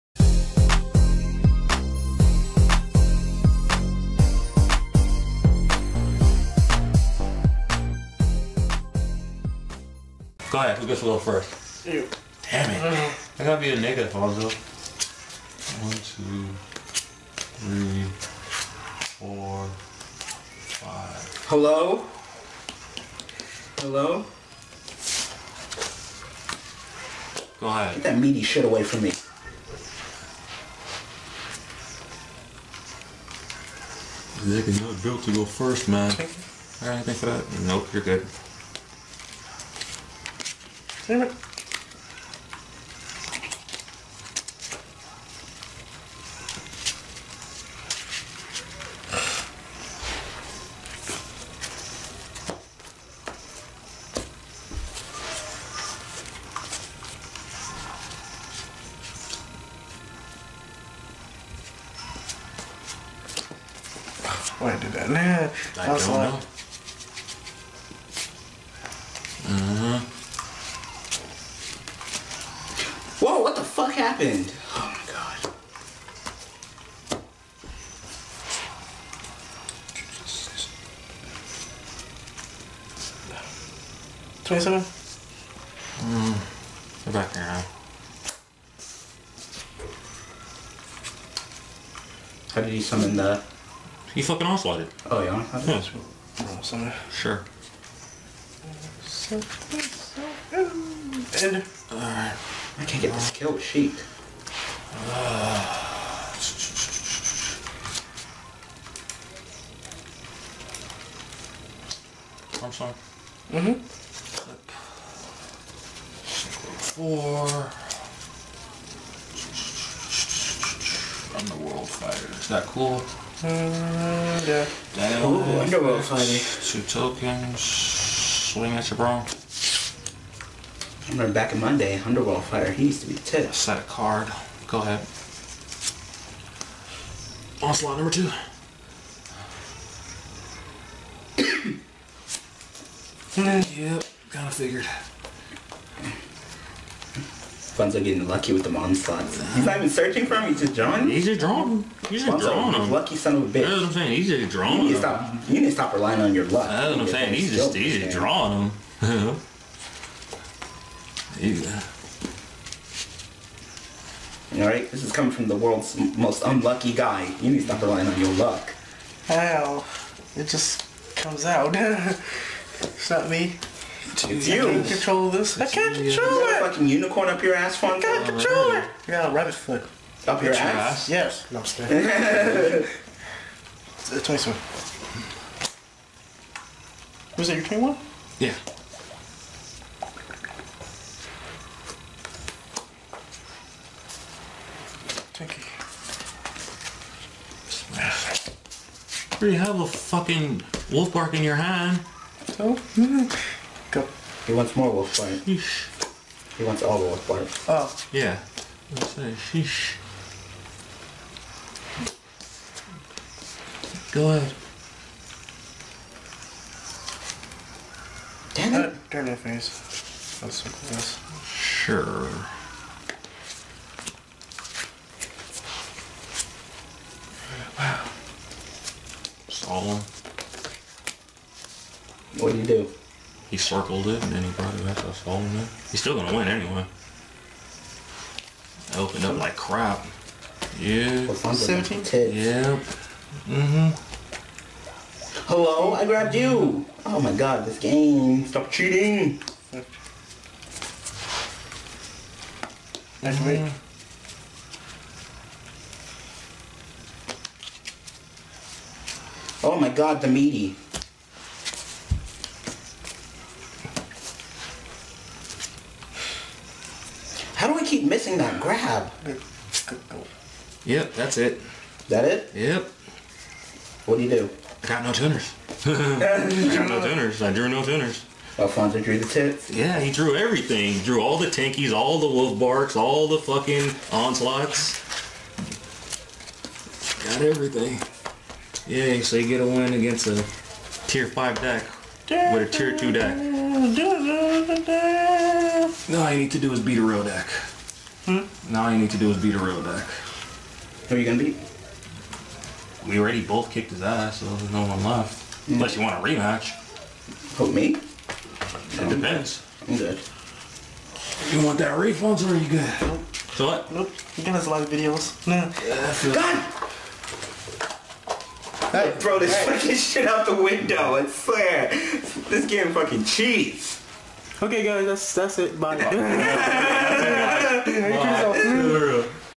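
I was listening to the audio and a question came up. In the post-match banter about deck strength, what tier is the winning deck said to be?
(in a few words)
tier 2.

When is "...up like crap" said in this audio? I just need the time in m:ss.
3:59.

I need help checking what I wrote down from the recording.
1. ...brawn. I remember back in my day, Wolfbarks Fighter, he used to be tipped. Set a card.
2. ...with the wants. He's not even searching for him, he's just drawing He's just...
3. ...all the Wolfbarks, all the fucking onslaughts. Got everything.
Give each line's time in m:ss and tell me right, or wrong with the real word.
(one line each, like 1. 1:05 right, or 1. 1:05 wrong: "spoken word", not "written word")
1. 2:08 wrong: "Underworld", not "Wolfbarks"
2. 2:28 wrong: "onslaughts", not "wants"
3. 4:41 right.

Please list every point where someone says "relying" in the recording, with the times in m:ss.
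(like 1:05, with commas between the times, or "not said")
2:35, 2:47.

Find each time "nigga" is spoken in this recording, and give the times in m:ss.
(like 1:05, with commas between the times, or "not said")
0:13, 0:34.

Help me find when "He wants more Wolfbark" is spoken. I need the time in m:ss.
3:24.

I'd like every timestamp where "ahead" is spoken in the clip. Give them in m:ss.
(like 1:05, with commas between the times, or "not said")
0:10, 0:27, 2:14, 3:34.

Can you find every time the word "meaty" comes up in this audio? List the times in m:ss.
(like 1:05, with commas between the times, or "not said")
0:28, 4:20.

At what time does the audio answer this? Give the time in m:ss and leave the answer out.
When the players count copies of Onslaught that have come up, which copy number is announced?
2:17.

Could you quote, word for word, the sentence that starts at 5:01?
Who are you going to beat?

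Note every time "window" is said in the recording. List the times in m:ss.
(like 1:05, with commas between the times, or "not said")
5:20.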